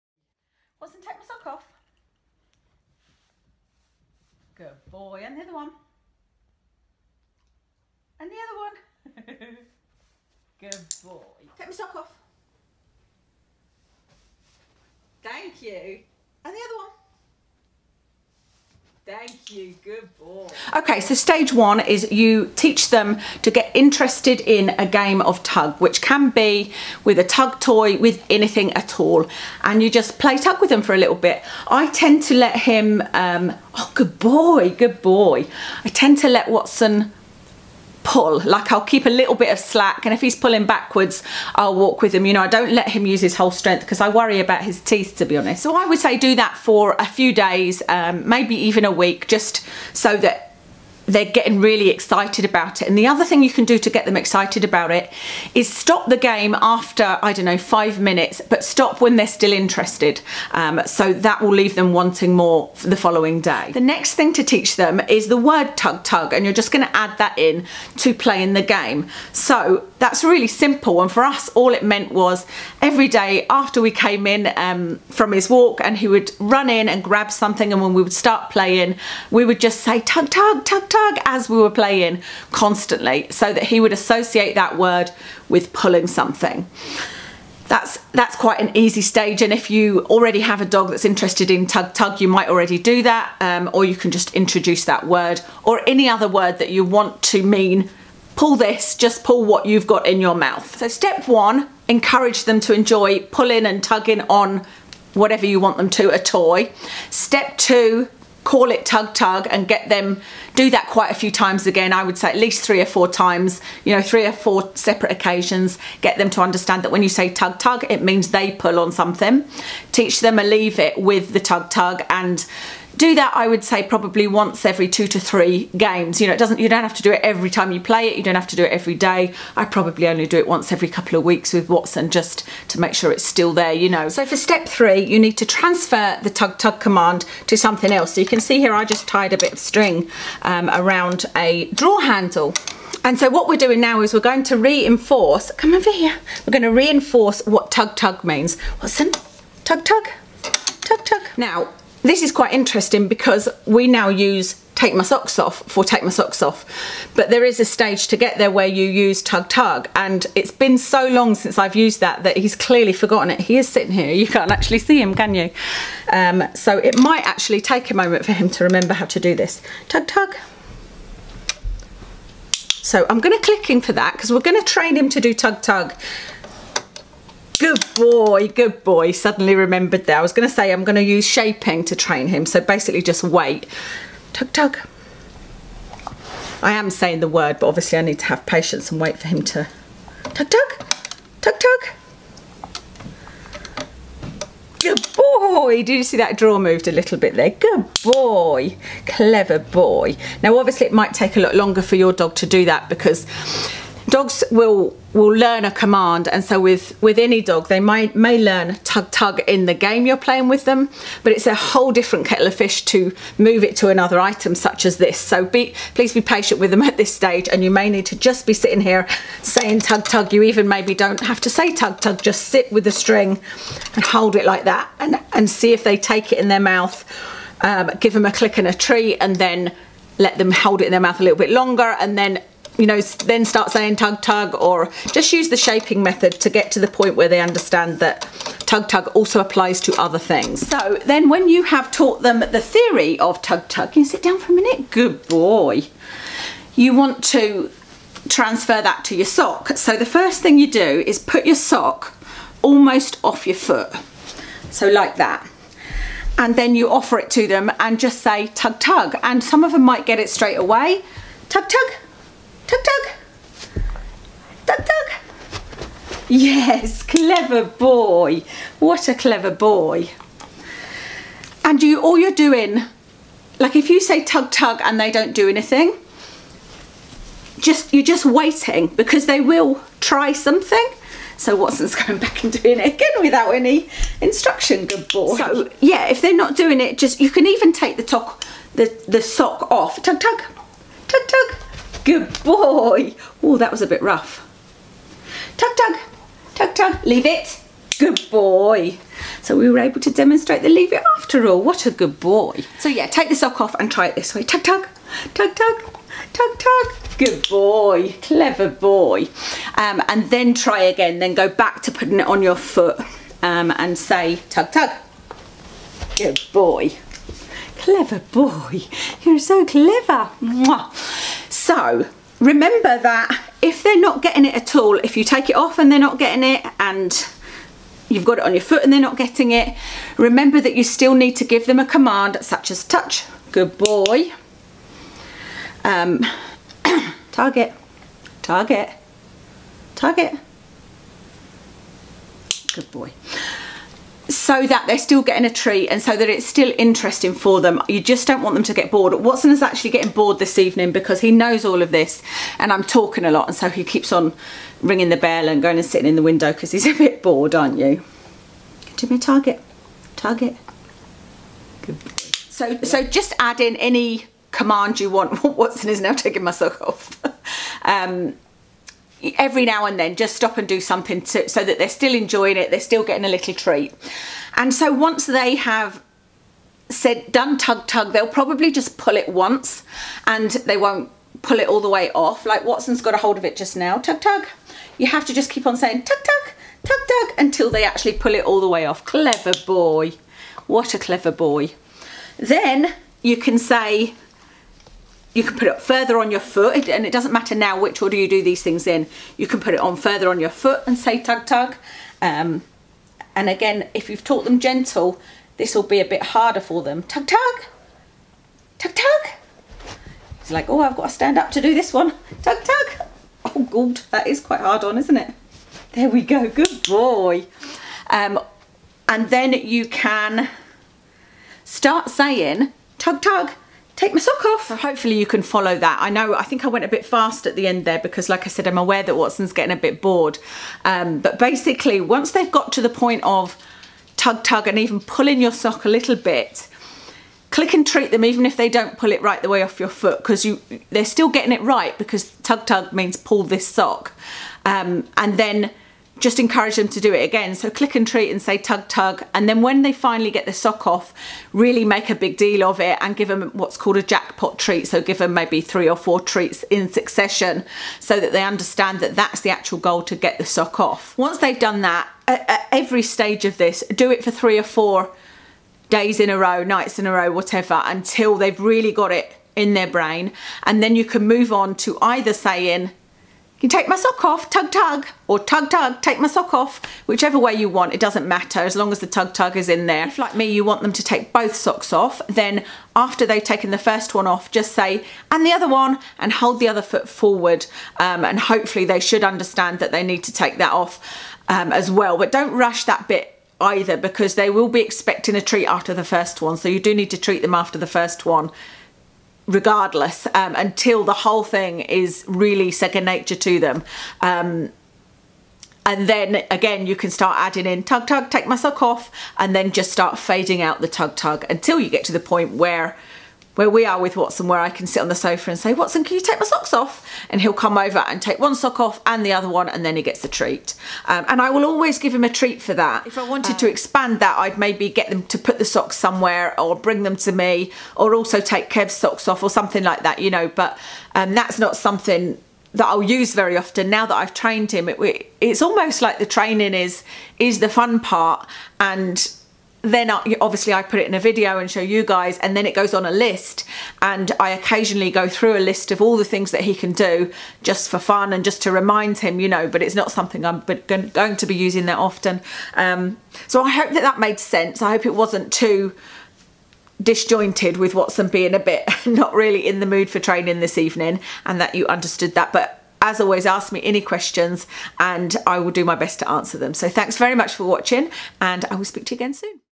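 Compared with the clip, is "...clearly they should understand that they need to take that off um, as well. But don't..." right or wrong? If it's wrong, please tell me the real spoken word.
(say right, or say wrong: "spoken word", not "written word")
wrong: "hopefully", not "clearly".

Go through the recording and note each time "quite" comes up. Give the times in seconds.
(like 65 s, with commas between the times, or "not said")
88 s, 110 s, 152 s, 414 s.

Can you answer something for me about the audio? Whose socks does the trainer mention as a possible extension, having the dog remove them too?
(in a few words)
Kev's.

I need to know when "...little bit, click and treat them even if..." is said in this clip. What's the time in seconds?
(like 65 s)
435 s.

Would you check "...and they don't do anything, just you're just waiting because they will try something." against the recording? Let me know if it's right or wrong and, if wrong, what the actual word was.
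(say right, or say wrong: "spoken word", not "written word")
right.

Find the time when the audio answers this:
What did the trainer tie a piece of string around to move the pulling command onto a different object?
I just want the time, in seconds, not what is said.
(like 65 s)
141 s.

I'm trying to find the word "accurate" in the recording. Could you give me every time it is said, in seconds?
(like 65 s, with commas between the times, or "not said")
not said.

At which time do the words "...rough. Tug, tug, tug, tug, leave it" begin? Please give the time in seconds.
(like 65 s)
294 s.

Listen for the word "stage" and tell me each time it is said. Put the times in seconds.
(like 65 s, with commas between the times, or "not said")
21 s, 88 s, 157 s, 217 s, 463 s.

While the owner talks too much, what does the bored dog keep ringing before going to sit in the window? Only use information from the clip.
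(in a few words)
the bell.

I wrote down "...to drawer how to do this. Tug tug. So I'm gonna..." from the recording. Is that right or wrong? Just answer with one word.
wrong.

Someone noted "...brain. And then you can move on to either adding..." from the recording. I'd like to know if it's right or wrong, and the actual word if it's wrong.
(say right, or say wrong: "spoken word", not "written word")
wrong: "saying", not "adding".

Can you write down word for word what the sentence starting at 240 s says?
So then when you have taught them the theory of tug tug, can you sit down for a minute?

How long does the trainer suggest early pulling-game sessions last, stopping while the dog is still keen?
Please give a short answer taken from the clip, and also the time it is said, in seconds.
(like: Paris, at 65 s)
5 minutes, at 57 s.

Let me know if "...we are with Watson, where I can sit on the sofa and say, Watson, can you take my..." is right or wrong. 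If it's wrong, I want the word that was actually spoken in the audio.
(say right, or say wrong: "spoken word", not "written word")
right.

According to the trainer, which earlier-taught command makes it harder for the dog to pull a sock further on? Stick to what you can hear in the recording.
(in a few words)
gentle.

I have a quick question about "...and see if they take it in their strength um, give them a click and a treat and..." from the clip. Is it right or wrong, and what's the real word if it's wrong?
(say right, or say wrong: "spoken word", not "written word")
wrong: "mouth", not "strength".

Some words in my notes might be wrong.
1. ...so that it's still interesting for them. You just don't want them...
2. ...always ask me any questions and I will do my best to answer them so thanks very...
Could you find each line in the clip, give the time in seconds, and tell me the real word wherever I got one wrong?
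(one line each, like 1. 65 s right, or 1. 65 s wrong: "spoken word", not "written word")
1. 346 s right
2. 563 s right.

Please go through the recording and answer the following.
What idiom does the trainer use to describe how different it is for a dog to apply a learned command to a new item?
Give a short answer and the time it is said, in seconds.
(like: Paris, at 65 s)
a whole different kettle of fish, at 211 s.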